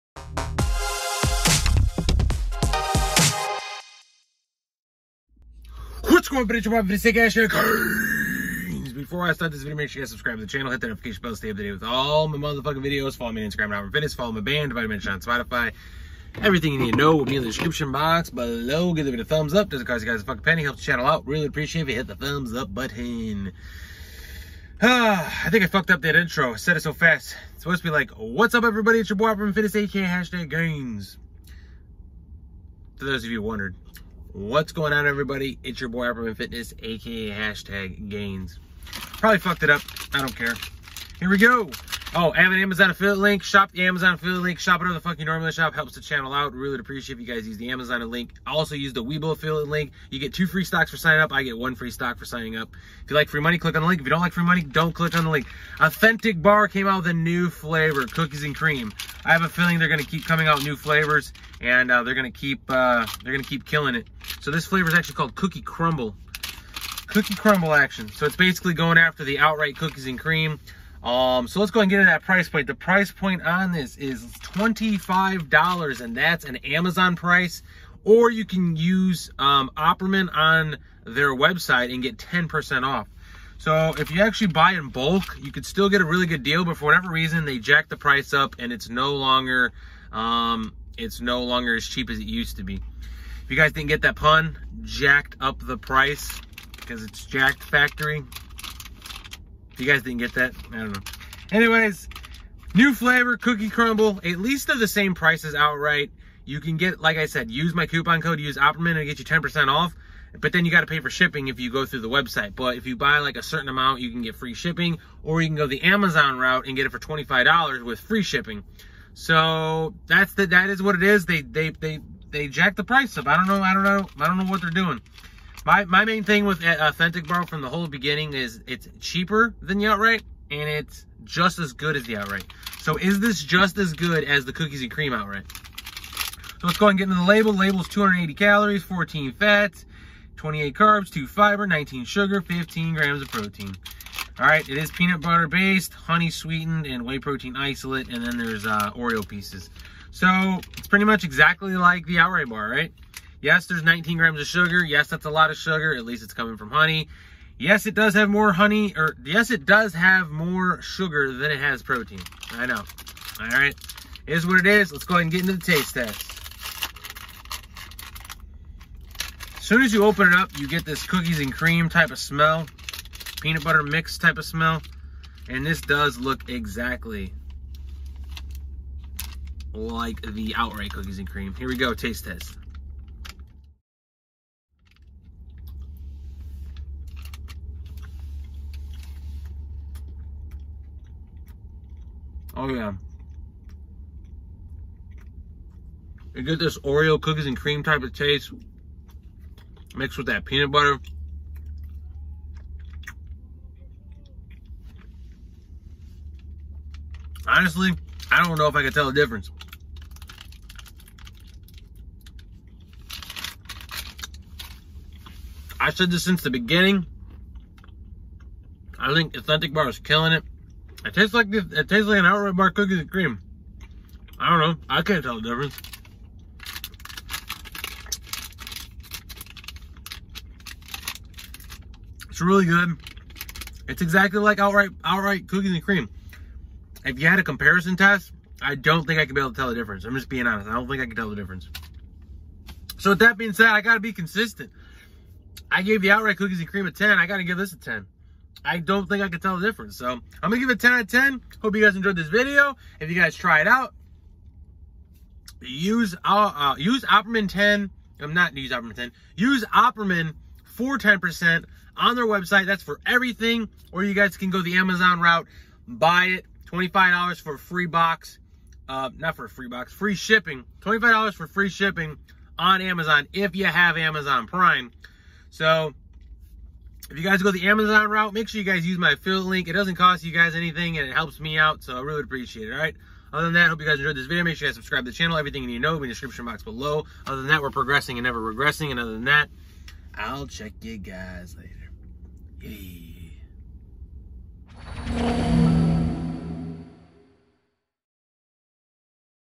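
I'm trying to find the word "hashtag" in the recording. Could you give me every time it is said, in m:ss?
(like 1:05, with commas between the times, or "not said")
0:30, 0:37.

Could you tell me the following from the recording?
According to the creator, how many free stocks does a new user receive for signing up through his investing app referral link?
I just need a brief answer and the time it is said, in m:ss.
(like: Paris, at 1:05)
2, at 0:50.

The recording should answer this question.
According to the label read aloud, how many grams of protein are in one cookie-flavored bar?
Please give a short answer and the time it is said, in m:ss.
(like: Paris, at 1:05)
15, at 2:22.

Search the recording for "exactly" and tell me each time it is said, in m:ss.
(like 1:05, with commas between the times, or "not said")
2:31, 2:56, 3:54.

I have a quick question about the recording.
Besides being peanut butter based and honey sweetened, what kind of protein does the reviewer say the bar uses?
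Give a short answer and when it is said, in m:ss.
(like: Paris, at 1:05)
whey protein isolate, at 2:27.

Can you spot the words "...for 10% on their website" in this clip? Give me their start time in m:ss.
4:20.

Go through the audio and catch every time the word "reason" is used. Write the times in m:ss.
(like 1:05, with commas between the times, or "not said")
1:27.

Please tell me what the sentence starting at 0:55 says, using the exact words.
Authentic Bar came out with a new flavor, cookies and cream.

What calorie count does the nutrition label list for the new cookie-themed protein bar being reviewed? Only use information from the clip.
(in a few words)
280.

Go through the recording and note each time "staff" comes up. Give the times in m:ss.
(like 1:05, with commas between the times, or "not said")
not said.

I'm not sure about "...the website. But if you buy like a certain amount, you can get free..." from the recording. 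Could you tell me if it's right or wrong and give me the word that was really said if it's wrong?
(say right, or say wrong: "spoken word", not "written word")
right.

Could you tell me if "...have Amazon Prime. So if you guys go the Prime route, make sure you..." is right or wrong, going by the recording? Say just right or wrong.
wrong.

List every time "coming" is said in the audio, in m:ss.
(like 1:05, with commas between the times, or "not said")
1:00, 2:36.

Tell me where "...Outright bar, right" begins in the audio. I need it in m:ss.
2:32.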